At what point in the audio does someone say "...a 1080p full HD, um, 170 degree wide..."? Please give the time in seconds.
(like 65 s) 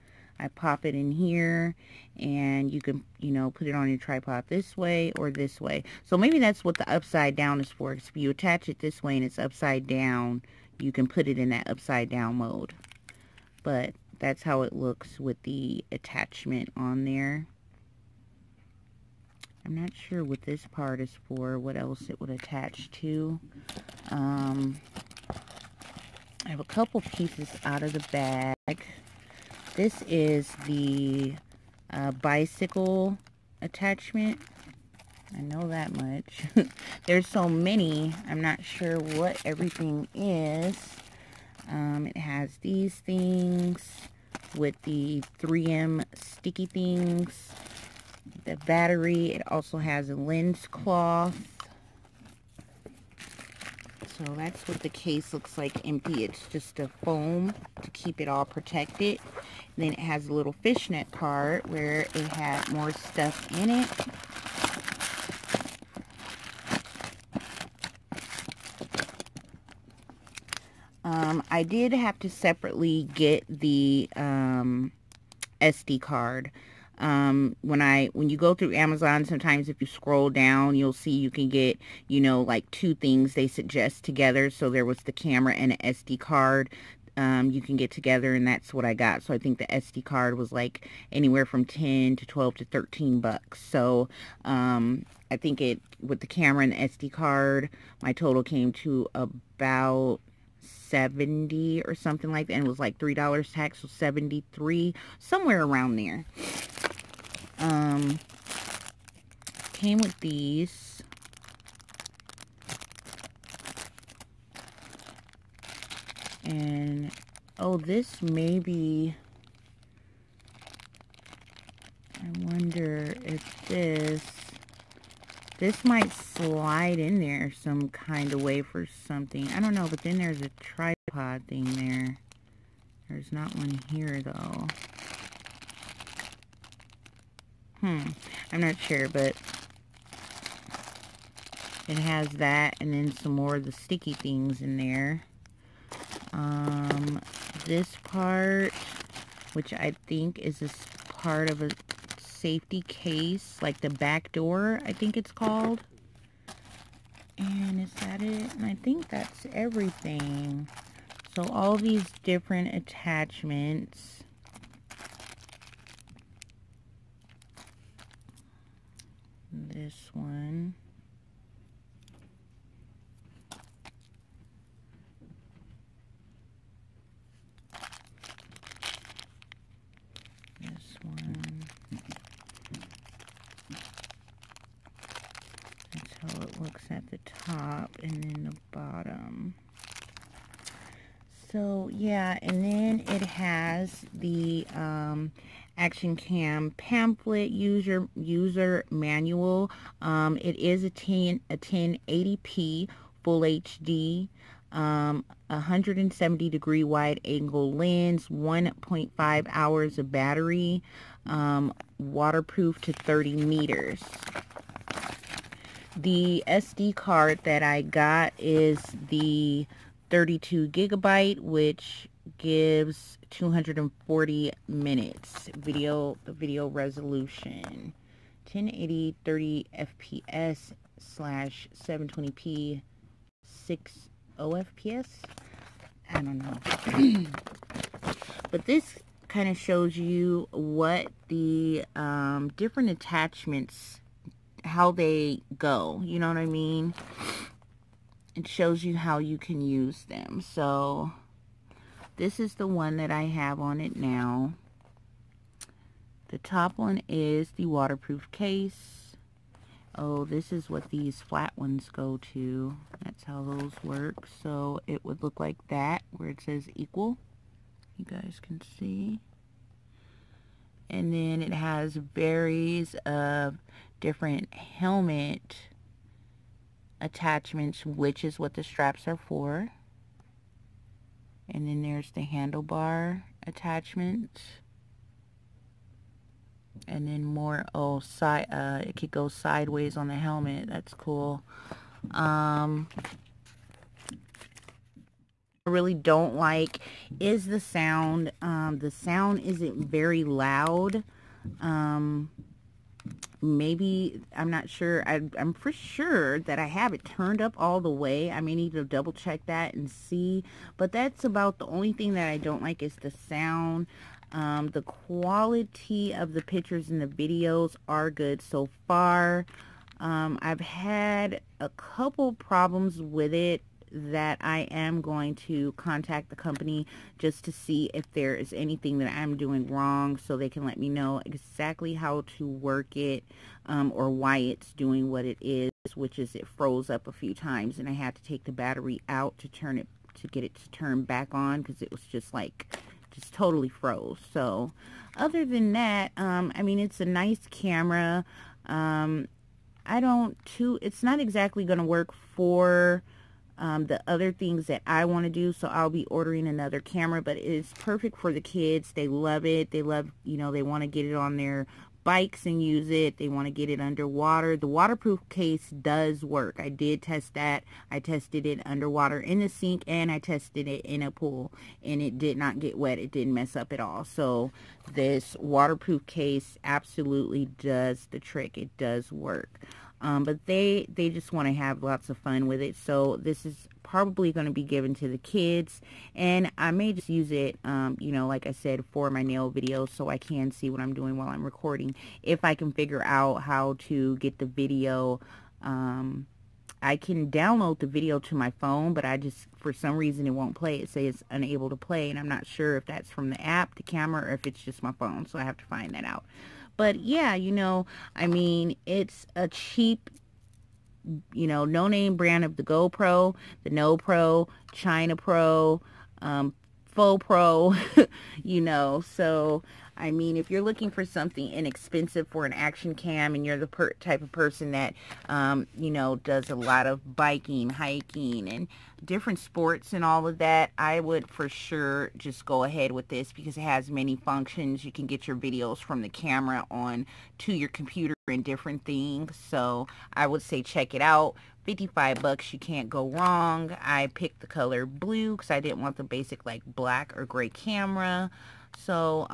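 201 s.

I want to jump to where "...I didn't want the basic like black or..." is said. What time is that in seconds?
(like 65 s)
445 s.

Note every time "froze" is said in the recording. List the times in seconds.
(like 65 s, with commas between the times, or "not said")
336 s, 343 s.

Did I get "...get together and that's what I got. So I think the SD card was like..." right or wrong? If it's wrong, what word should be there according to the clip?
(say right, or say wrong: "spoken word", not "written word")
right.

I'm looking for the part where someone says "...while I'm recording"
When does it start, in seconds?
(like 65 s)
391 s.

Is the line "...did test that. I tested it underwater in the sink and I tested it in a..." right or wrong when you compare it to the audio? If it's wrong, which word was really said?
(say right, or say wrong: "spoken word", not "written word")
right.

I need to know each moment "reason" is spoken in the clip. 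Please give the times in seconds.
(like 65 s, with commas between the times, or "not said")
399 s.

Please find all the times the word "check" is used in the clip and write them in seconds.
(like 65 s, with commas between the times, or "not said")
309 s, 440 s.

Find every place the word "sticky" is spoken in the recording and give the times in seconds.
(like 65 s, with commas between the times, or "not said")
46 s, 143 s.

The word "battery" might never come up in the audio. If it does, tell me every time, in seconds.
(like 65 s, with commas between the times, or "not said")
48 s, 210 s, 338 s.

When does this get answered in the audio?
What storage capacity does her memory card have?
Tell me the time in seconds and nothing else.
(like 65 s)
220 s.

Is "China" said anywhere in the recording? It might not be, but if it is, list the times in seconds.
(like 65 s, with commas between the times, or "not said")
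414 s.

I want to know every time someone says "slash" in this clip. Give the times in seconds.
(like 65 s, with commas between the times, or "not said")
230 s.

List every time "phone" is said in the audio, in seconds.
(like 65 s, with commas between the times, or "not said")
398 s, 404 s.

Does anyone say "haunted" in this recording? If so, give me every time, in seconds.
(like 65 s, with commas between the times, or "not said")
not said.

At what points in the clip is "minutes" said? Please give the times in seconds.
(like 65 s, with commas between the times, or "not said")
224 s.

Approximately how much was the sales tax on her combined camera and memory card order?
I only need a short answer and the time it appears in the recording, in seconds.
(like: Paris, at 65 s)
$3, at 102 s.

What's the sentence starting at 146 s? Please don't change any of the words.
Um, this part, which I think is this part of a safety case, like the back door, I think it's called.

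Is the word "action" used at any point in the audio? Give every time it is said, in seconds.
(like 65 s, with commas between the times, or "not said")
195 s, 422 s.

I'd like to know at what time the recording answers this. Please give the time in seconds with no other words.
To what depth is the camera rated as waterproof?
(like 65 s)
212 s.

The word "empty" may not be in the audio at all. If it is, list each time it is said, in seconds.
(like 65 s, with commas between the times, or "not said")
55 s.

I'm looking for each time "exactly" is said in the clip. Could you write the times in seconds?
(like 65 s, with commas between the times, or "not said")
331 s, 351 s.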